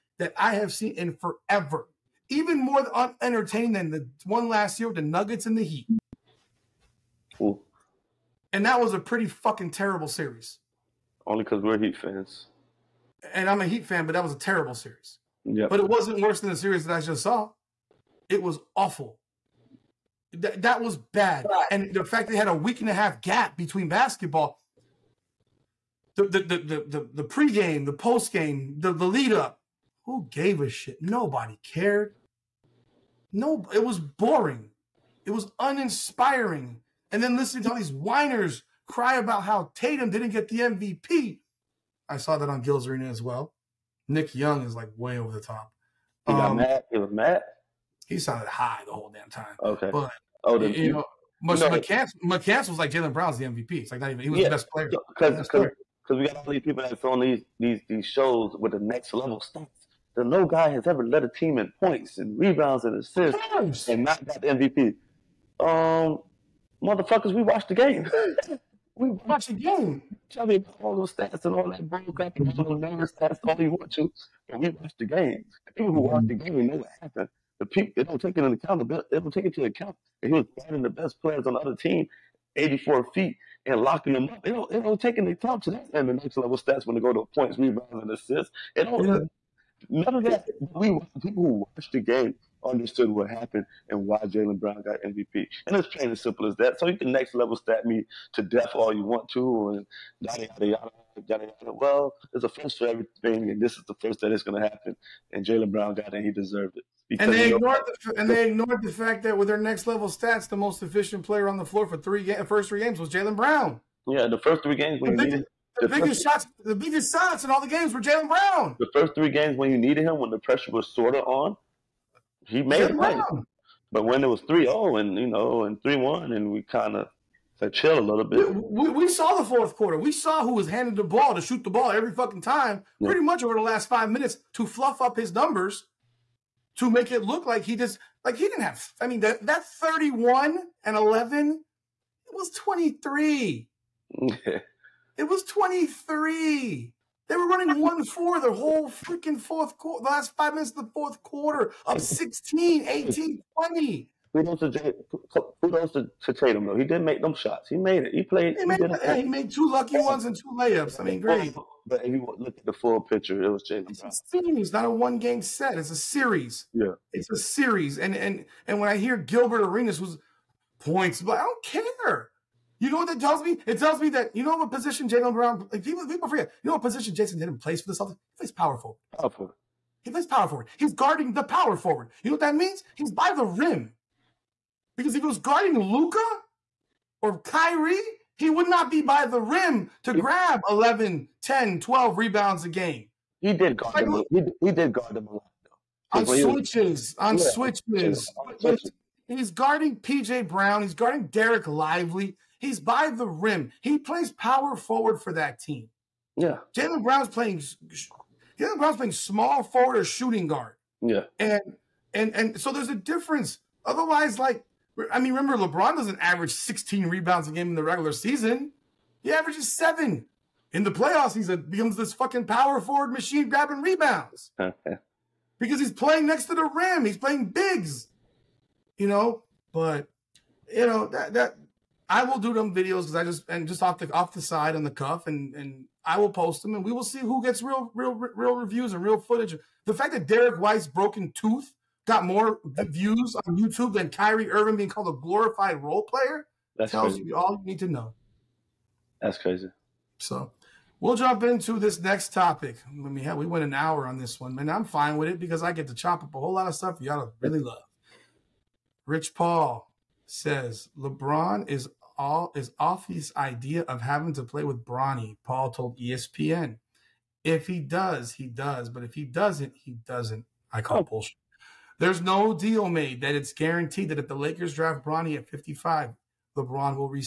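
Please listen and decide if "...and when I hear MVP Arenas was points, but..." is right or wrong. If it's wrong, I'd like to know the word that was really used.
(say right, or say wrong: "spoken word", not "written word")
wrong: "Gilbert", not "MVP".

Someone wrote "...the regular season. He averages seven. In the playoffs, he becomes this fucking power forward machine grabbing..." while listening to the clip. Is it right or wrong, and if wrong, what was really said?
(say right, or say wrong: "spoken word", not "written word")
right.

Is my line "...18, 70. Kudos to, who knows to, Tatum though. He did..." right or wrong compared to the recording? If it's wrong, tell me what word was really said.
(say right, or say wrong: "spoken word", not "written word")
wrong: "20", not "70".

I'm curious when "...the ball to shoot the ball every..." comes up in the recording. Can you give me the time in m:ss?
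2:10.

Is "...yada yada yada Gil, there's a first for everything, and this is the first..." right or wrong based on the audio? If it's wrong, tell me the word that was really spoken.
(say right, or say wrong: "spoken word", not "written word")
wrong: "Well", not "Gil".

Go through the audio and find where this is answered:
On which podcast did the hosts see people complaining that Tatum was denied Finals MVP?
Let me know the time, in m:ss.
0:42.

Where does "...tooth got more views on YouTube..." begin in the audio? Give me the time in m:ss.
4:01.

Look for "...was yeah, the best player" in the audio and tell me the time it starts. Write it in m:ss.
0:54.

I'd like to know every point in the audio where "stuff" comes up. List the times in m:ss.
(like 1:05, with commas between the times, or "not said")
0:59, 4:16.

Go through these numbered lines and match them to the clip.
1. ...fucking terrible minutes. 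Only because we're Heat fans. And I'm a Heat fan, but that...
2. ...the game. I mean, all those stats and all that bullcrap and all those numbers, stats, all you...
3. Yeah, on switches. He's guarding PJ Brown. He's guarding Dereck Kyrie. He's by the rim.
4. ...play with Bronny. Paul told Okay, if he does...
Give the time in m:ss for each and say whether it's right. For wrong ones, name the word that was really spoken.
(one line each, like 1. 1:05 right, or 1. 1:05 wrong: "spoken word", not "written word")
1. 0:09 wrong: "series", not "minutes"
2. 1:09 right
3. 3:17 wrong: "Lively", not "Kyrie"
4. 4:24 wrong: "ESPN", not "Okay".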